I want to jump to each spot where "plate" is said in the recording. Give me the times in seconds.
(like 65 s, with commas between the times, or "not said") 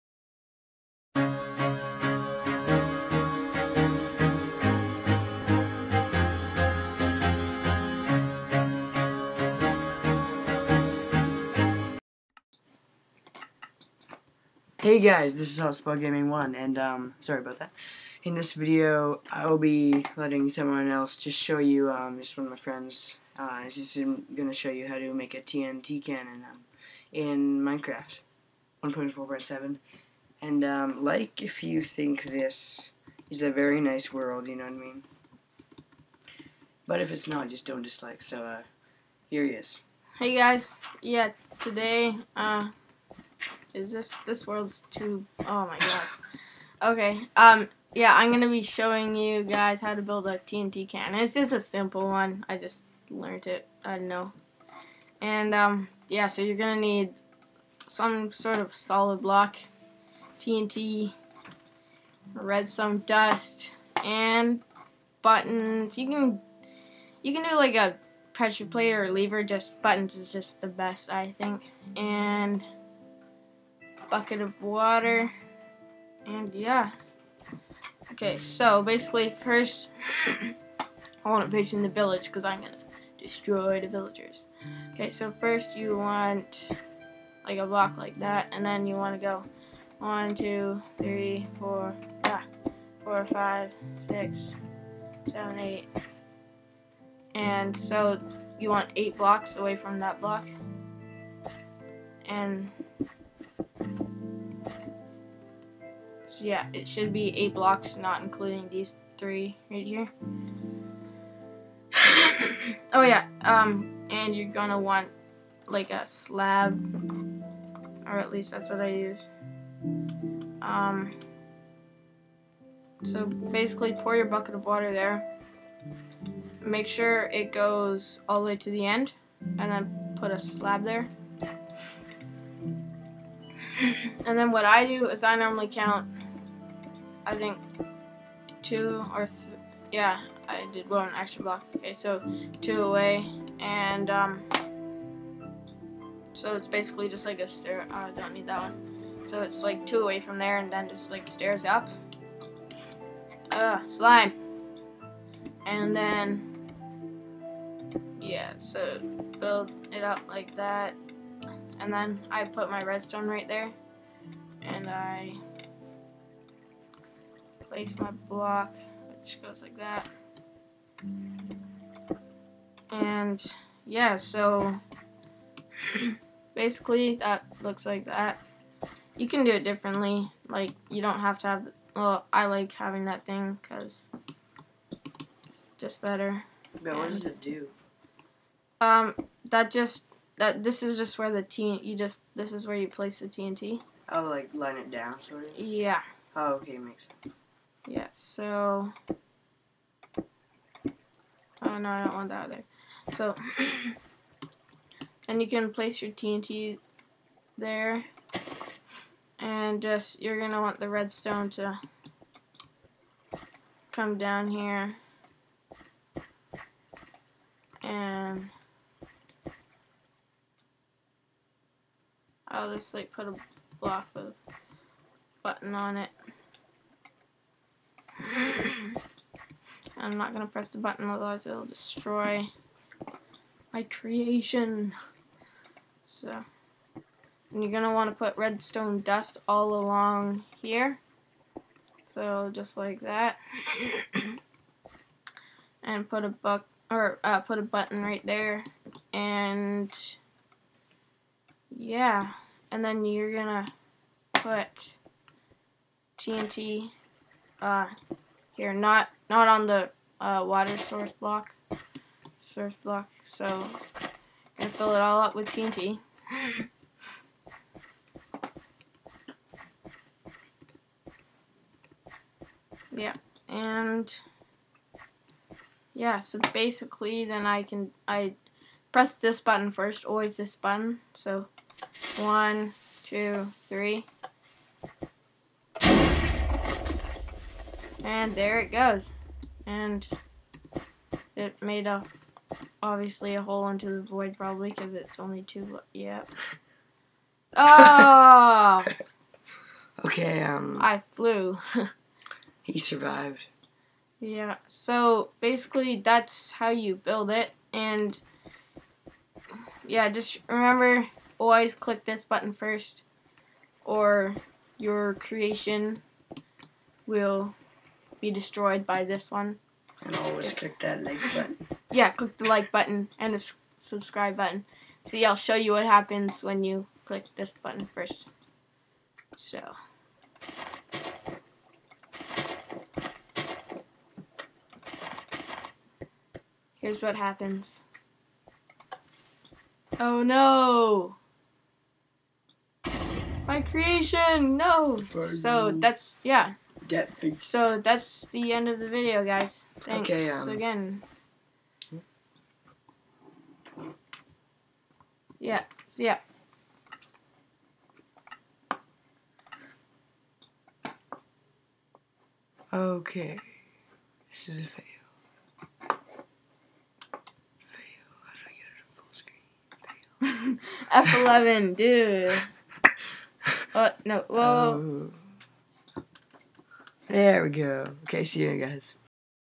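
68 s.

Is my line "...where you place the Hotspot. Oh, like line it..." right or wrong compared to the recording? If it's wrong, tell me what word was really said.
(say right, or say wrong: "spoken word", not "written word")
wrong: "TNT", not "Hotspot".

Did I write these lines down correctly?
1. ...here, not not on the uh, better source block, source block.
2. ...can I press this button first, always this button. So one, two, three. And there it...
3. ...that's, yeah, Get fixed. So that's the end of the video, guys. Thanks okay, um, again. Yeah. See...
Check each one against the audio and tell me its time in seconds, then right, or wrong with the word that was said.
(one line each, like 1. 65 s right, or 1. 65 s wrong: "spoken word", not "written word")
1. 258 s wrong: "water", not "better"
2. 277 s right
3. 345 s right.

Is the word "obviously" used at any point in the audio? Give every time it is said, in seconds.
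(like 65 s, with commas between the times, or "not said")
292 s.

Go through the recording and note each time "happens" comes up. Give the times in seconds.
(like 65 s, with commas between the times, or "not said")
325 s, 337 s.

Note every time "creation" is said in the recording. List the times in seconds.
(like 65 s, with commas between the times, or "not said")
233 s, 315 s, 343 s.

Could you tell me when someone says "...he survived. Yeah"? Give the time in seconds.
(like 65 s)
302 s.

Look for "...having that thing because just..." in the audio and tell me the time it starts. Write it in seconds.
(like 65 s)
182 s.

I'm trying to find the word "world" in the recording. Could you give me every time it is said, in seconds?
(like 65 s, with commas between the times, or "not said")
34 s, 44 s.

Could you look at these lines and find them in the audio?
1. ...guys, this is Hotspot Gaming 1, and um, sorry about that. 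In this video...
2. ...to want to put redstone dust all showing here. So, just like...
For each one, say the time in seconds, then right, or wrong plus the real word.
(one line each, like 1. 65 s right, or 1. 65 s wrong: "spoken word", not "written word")
1. 14 s right
2. 237 s wrong: "along", not "showing".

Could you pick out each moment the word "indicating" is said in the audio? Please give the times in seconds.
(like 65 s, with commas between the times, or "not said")
not said.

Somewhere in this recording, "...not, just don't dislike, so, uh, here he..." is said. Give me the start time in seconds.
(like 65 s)
37 s.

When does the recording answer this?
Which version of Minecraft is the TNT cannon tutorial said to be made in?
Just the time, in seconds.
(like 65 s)
27 s.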